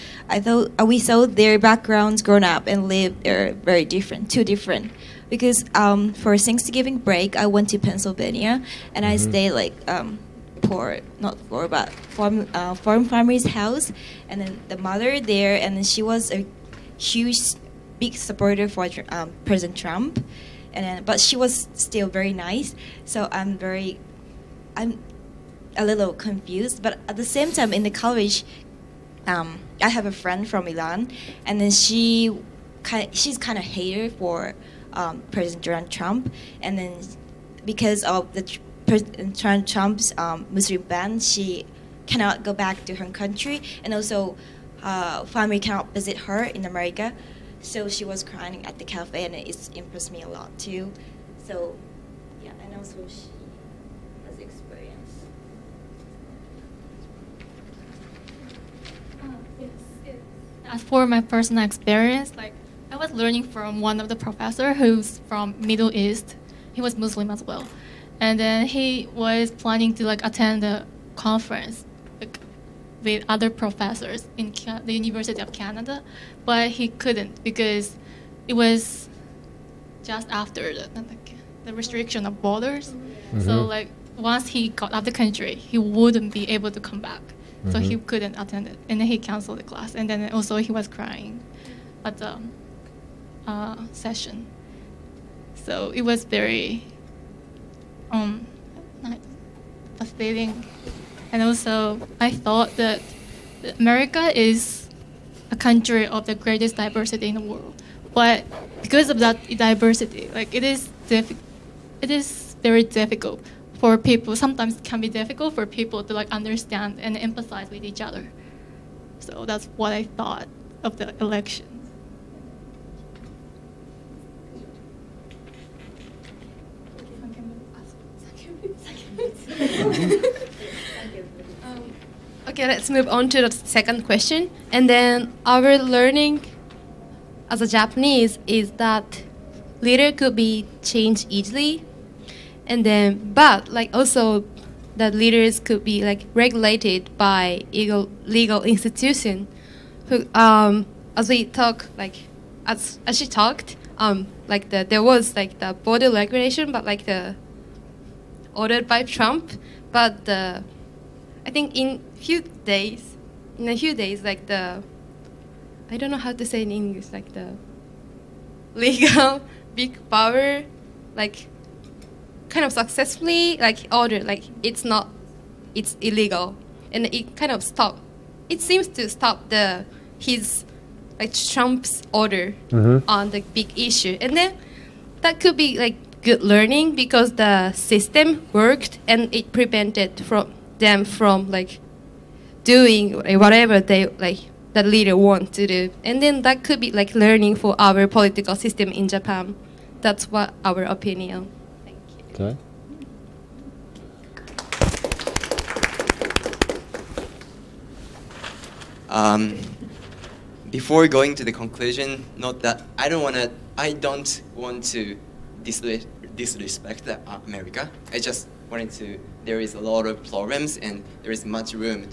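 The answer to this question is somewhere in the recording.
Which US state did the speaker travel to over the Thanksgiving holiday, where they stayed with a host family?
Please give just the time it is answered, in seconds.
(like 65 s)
7 s.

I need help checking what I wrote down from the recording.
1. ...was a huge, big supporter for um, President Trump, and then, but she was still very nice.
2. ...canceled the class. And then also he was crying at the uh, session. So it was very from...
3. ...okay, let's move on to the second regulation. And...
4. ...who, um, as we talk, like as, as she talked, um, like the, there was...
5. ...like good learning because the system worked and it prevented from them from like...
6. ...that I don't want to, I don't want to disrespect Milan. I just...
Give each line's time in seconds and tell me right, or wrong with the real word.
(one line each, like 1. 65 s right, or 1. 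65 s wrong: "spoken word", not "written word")
1. 16 s right
2. 89 s right
3. 132 s wrong: "question", not "regulation"
4. 150 s right
5. 185 s right
6. 212 s wrong: "America", not "Milan".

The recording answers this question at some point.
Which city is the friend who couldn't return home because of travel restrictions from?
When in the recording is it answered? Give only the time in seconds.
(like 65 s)
30 s.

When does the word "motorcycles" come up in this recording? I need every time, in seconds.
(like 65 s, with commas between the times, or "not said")
not said.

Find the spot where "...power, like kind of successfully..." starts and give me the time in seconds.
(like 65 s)
170 s.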